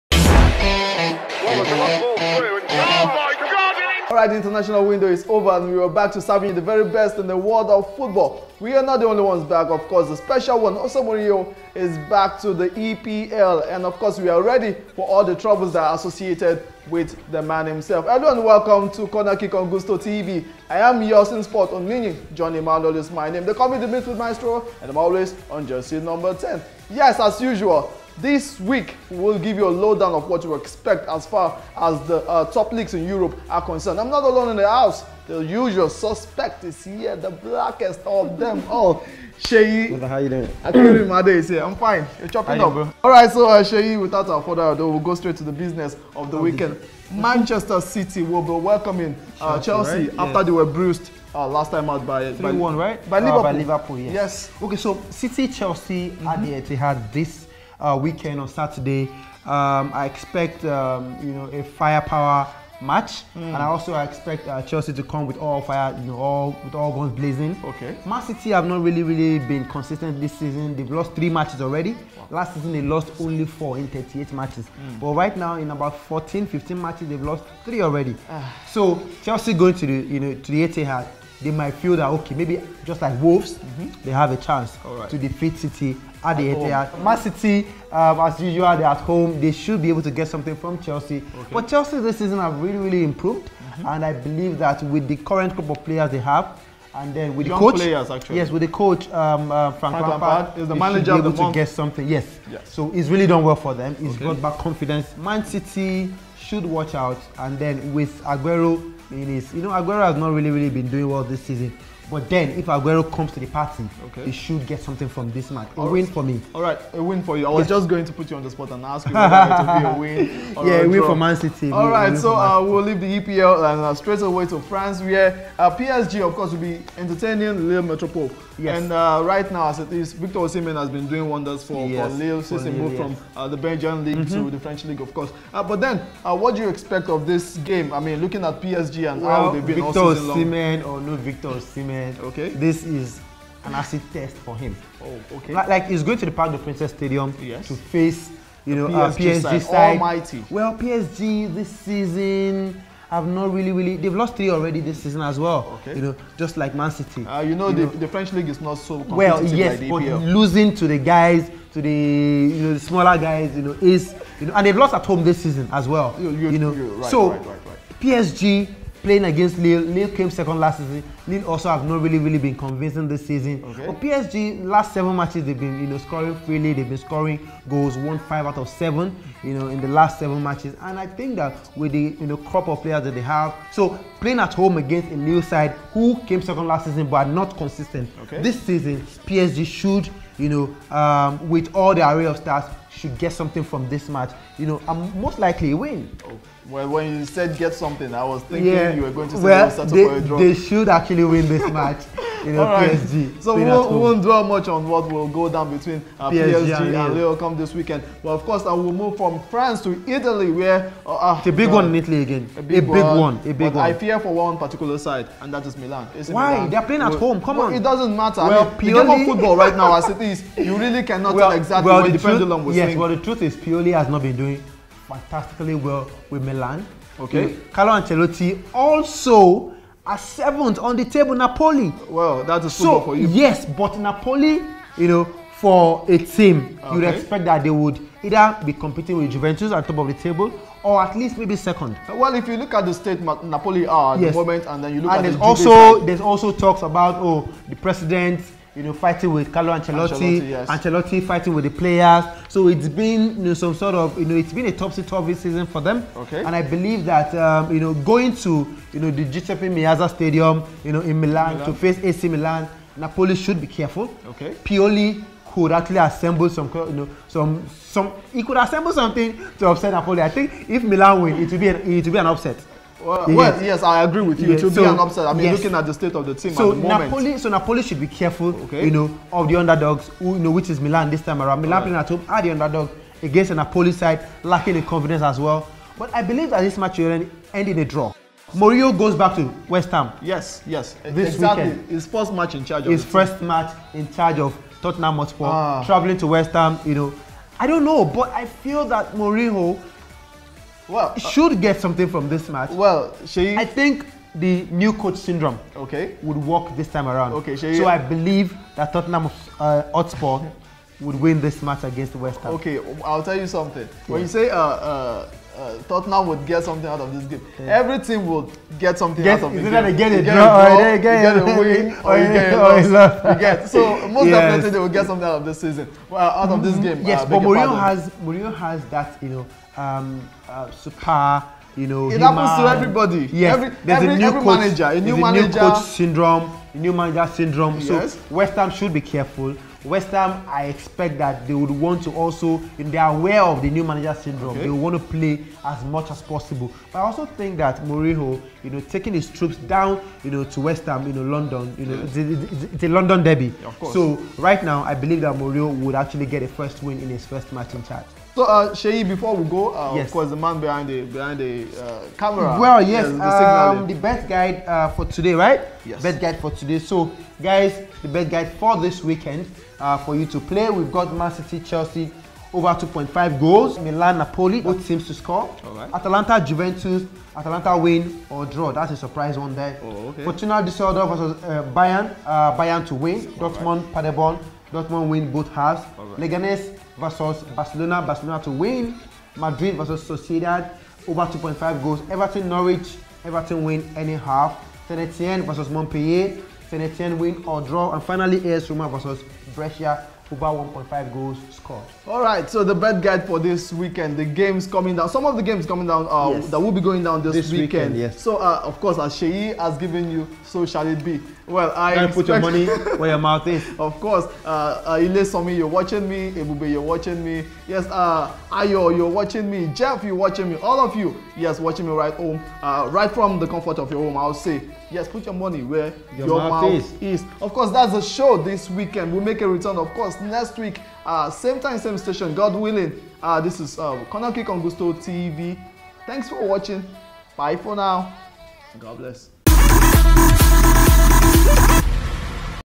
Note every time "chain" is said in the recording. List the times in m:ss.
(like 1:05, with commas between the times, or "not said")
not said.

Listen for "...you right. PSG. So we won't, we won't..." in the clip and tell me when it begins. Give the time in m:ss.
3:22.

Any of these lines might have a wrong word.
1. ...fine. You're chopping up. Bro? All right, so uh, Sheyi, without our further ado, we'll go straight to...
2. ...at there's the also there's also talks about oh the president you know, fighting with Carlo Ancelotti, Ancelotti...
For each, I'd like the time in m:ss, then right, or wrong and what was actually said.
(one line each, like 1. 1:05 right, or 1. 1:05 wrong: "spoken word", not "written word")
1. 0:41 right
2. 4:05 right.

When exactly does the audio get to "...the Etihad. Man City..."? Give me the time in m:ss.
1:26.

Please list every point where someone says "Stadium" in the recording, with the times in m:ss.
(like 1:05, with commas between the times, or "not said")
2:26, 4:20.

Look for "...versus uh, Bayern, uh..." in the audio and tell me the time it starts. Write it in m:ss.
6:21.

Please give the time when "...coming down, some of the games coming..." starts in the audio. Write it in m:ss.
6:44.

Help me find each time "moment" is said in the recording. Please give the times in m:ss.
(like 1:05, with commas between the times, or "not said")
4:04, 4:36.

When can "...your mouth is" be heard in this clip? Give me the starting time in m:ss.
6:53.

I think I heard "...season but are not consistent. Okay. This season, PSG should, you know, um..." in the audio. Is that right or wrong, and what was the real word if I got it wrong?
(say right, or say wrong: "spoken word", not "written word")
right.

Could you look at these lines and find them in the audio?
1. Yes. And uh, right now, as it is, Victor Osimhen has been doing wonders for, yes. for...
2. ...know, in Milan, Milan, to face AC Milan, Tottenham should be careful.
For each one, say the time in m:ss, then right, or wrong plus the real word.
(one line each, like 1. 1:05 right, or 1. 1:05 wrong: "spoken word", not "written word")
1. 2:08 right
2. 4:20 wrong: "Napoli", not "Tottenham".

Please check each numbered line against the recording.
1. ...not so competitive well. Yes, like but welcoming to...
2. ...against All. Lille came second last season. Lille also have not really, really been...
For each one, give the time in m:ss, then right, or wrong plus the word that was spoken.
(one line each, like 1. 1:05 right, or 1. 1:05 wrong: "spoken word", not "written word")
1. 2:38 wrong: "losing", not "welcoming"
2. 2:49 wrong: "Lille", not "All".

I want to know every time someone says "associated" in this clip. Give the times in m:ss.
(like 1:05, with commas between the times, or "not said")
0:15.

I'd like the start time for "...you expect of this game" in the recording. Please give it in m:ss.
2:16.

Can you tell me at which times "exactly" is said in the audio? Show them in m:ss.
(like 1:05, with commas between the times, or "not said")
3:41, 4:51.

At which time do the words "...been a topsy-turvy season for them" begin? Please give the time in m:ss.
4:14.